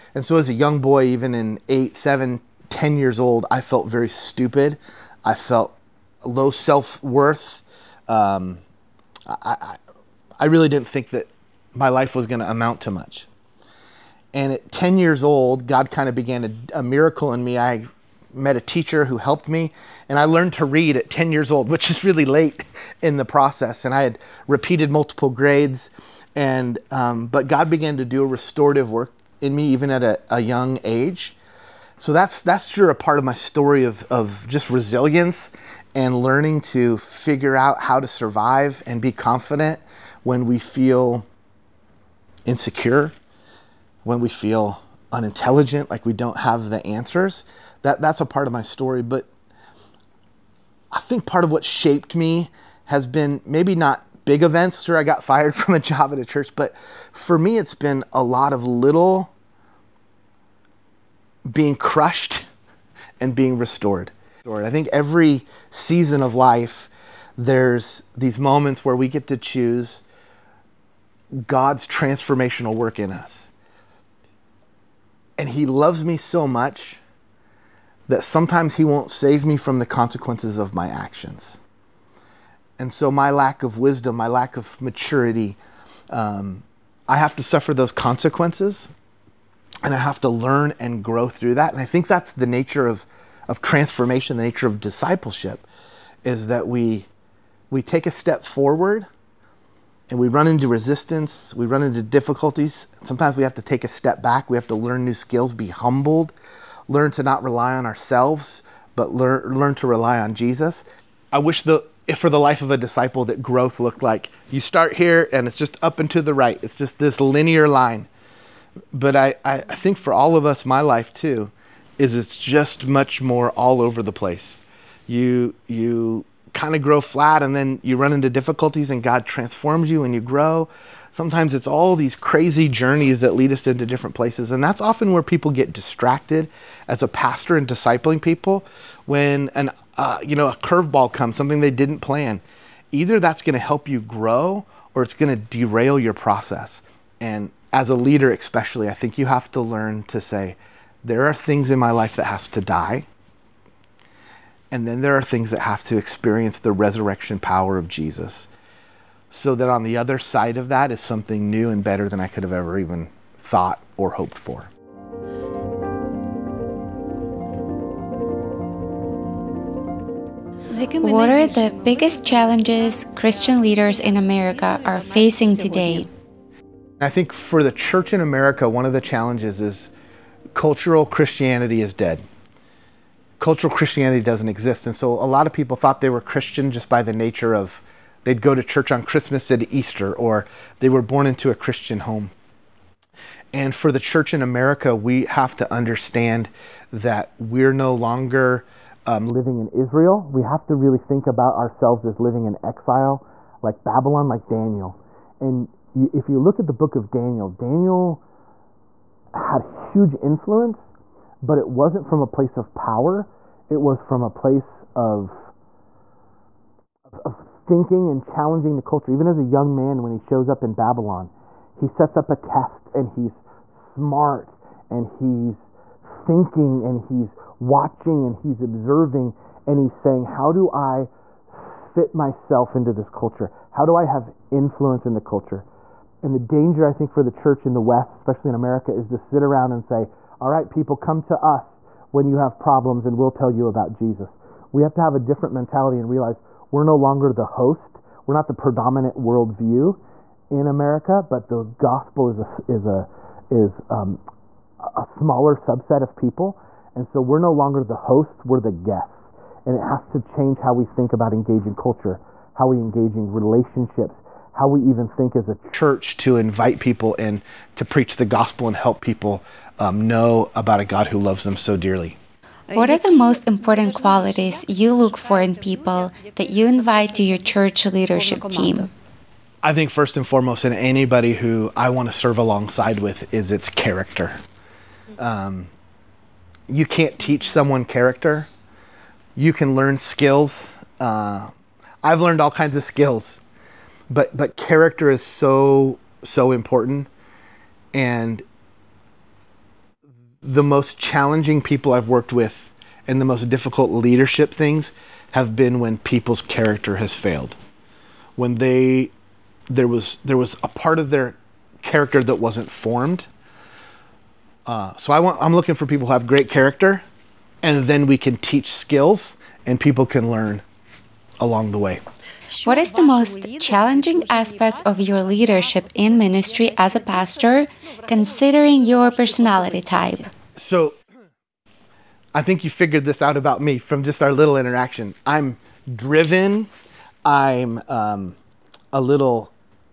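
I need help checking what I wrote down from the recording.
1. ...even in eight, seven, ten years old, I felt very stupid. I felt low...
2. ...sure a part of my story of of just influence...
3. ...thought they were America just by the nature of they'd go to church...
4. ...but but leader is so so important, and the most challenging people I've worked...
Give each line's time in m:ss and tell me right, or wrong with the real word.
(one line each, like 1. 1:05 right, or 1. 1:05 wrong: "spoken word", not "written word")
1. 0:01 right
2. 0:32 wrong: "resilience", not "influence"
3. 3:05 wrong: "Christian", not "America"
4. 4:54 wrong: "character", not "leader".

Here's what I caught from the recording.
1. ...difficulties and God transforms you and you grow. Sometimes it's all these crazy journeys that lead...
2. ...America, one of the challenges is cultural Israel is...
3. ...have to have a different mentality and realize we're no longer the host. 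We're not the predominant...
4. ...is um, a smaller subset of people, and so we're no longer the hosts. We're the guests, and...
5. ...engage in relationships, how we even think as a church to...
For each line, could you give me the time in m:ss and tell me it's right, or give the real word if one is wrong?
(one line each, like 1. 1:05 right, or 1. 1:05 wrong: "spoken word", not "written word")
1. 2:08 right
2. 2:58 wrong: "Christianity", not "Israel"
3. 4:04 right
4. 4:13 right
5. 4:22 right.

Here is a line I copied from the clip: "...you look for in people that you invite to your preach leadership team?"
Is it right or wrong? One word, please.
wrong.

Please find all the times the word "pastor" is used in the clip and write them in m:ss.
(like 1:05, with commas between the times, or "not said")
2:17, 5:26.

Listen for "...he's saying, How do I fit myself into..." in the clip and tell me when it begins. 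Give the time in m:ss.
3:49.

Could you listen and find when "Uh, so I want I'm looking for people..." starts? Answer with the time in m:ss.
5:14.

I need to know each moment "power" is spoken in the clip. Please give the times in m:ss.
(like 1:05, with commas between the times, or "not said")
2:37, 3:32.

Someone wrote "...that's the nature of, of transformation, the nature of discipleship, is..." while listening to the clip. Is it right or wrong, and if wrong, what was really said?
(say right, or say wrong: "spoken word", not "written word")
right.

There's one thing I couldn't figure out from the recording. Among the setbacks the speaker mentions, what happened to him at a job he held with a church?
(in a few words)
Got fired.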